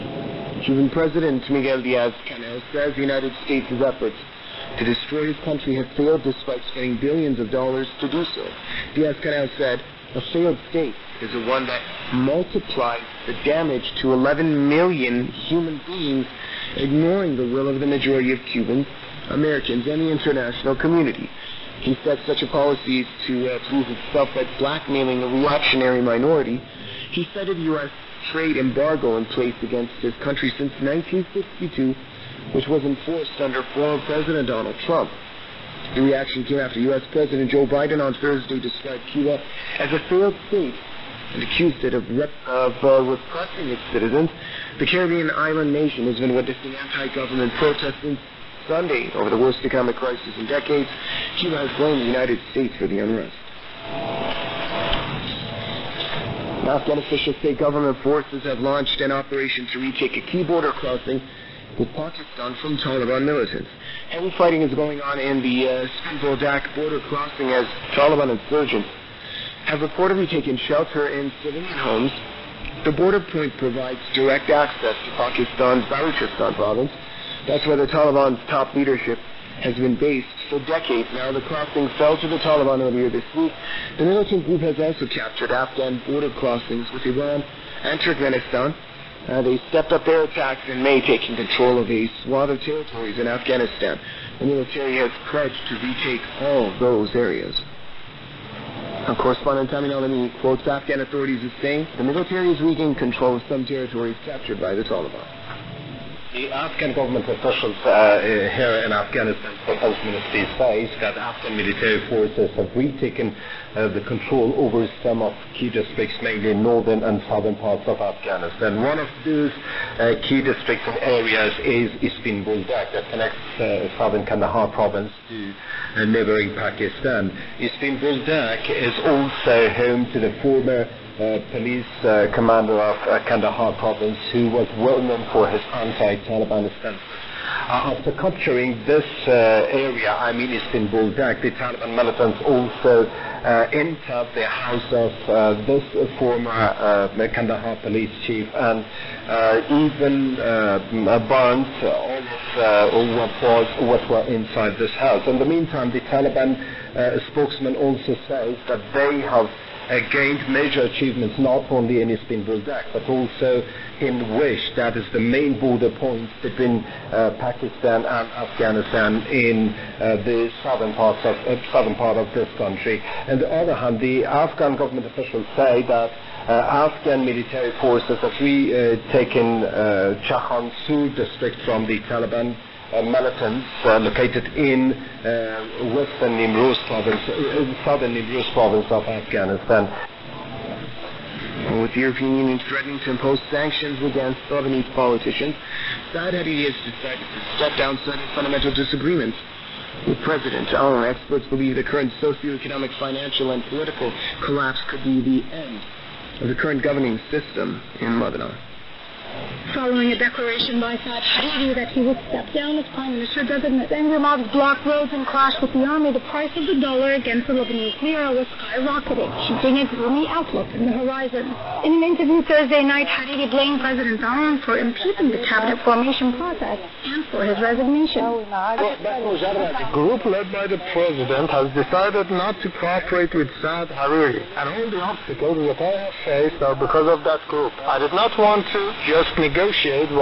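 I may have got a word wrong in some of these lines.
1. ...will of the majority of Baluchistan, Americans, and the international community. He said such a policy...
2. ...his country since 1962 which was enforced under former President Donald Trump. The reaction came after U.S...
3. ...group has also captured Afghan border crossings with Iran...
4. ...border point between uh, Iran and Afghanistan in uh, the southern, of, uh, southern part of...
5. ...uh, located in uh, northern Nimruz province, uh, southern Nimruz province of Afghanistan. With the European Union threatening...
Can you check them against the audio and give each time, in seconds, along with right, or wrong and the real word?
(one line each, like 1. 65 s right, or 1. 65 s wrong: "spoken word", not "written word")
1. 17 s wrong: "Cubans", not "Baluchistan"
2. 30 s right
3. 84 s right
4. 165 s wrong: "Pakistan", not "Iran"
5. 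183 s wrong: "western", not "northern".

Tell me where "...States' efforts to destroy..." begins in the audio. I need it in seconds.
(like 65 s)
3 s.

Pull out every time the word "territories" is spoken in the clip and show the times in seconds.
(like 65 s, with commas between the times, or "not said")
92 s, 103 s.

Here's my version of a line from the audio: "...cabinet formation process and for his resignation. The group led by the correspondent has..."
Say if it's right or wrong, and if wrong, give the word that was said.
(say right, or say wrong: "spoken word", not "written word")
wrong: "president", not "correspondent".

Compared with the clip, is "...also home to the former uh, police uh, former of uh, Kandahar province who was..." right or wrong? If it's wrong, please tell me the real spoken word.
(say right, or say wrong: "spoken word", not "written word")
wrong: "commander", not "former".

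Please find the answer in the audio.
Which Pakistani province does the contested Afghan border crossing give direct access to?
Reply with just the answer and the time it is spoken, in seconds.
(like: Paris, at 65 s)
Baluchistan, at 75 s.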